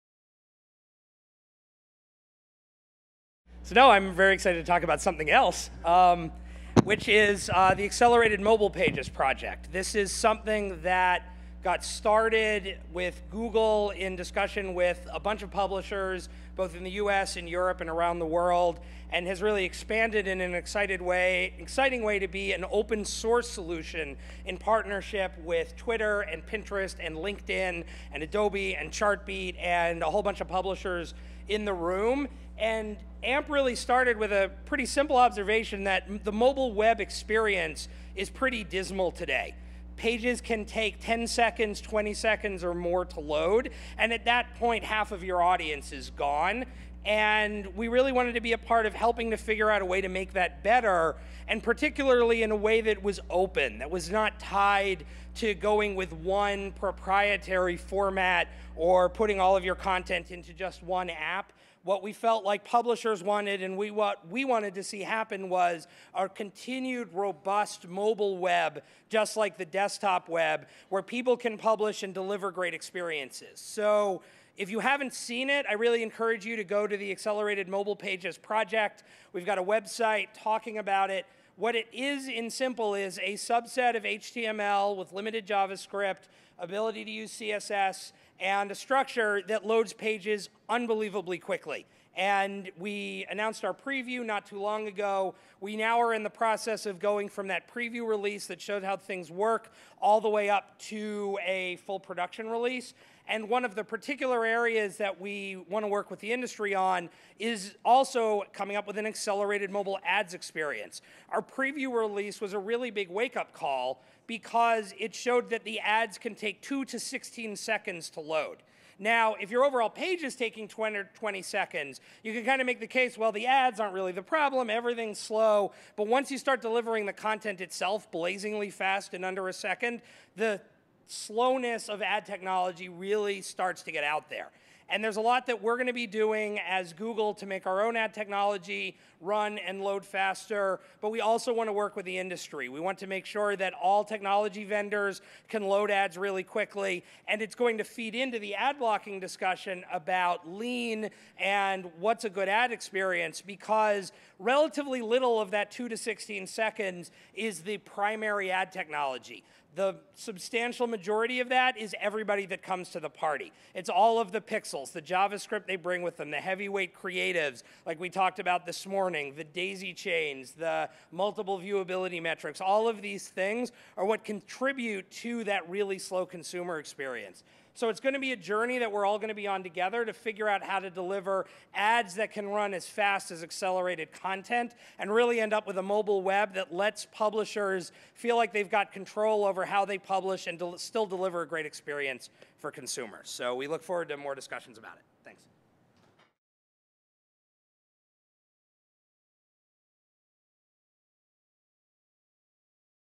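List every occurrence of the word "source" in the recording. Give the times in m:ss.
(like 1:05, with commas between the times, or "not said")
0:23.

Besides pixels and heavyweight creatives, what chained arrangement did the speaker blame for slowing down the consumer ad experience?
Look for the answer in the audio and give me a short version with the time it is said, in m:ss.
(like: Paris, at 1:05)
daisy chains, at 2:49.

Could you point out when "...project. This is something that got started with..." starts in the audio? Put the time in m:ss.
0:09.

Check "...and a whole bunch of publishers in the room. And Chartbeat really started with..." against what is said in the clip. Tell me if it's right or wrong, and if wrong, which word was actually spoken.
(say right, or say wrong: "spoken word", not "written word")
wrong: "AMP", not "Chartbeat".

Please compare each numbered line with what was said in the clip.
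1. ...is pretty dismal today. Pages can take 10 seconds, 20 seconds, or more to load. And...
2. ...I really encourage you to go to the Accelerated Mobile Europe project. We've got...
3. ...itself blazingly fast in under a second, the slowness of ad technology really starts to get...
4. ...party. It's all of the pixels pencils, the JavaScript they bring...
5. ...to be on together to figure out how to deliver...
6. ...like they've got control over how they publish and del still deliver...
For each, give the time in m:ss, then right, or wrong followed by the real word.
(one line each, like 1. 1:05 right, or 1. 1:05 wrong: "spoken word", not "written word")
1. 0:38 right
2. 1:15 wrong: "Pages", not "Europe"
3. 2:07 right
4. 2:43 right
5. 2:59 right
6. 3:08 right.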